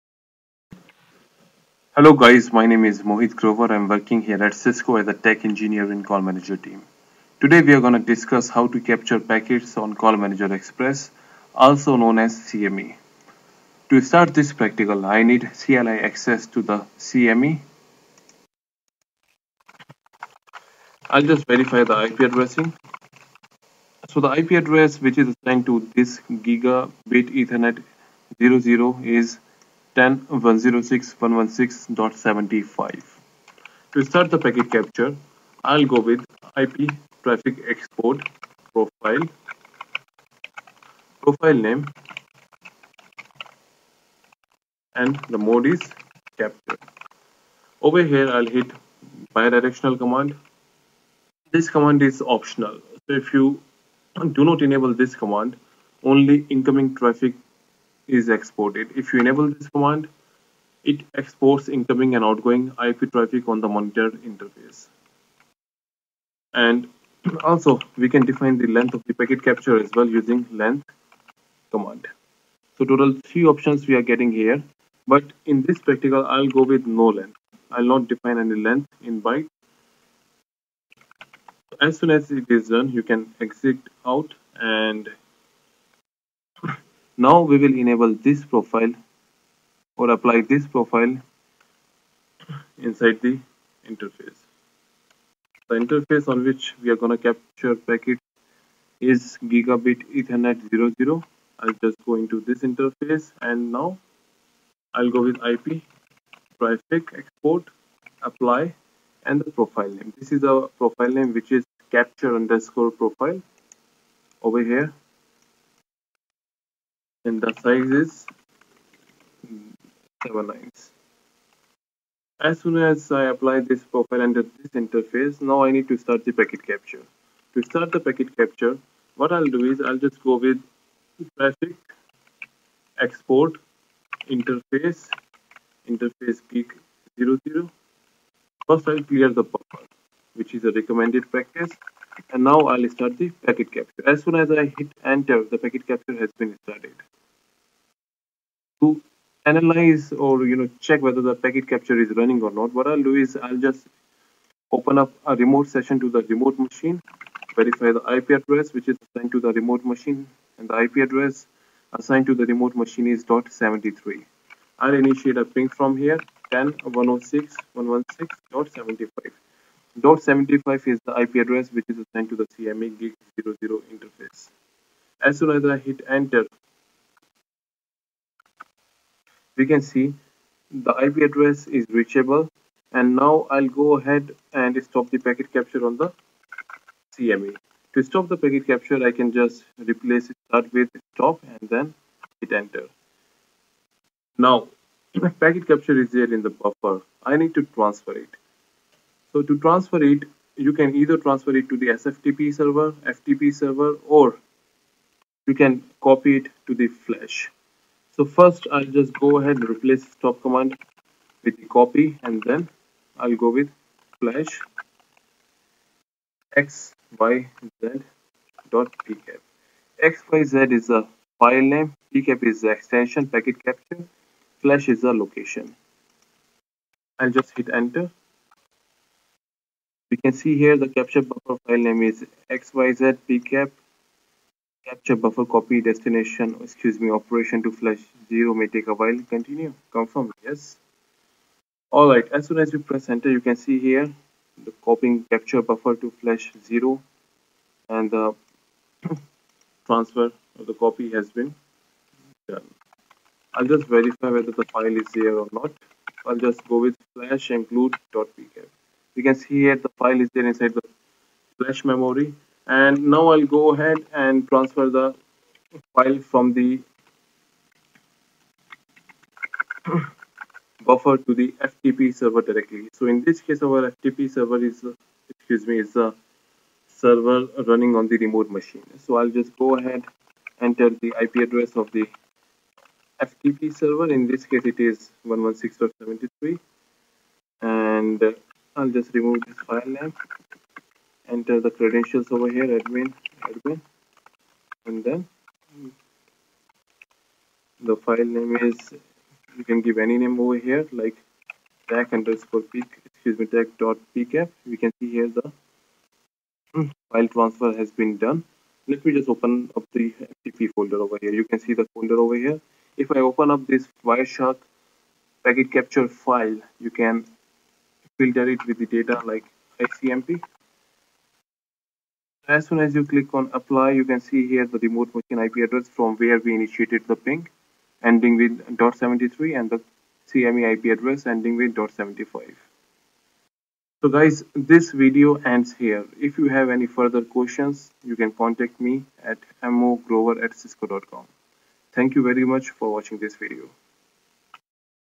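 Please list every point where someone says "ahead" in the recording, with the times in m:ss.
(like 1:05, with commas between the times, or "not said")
3:03, 3:29, 4:23, 4:39.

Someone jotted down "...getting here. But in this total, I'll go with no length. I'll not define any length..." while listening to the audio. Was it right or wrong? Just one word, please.
wrong.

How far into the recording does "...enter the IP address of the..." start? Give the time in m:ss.
4:40.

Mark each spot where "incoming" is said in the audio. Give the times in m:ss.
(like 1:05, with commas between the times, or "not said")
0:56, 1:01.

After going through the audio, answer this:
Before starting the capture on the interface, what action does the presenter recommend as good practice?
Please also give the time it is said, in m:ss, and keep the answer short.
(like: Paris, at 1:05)
clear the buffer, at 2:19.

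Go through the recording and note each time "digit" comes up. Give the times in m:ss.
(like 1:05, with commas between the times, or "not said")
not said.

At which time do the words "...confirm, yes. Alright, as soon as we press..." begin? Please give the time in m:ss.
3:59.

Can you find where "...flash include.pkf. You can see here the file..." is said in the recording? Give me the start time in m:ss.
4:17.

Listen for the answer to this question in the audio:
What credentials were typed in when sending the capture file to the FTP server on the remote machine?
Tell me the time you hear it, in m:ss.
4:52.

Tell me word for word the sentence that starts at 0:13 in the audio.
To start this practical, I need CLI access to the CME.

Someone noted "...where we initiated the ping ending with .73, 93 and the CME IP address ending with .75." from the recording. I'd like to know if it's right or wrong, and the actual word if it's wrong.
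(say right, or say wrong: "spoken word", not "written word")
wrong: "73", not "93".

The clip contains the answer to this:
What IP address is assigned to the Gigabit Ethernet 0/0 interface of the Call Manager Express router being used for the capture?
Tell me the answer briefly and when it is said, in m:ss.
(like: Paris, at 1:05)
10.106.116.75, at 0:29.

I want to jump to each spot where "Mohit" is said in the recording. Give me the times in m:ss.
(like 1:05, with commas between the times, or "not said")
0:03.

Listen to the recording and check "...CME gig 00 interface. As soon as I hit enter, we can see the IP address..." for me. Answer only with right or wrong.
right.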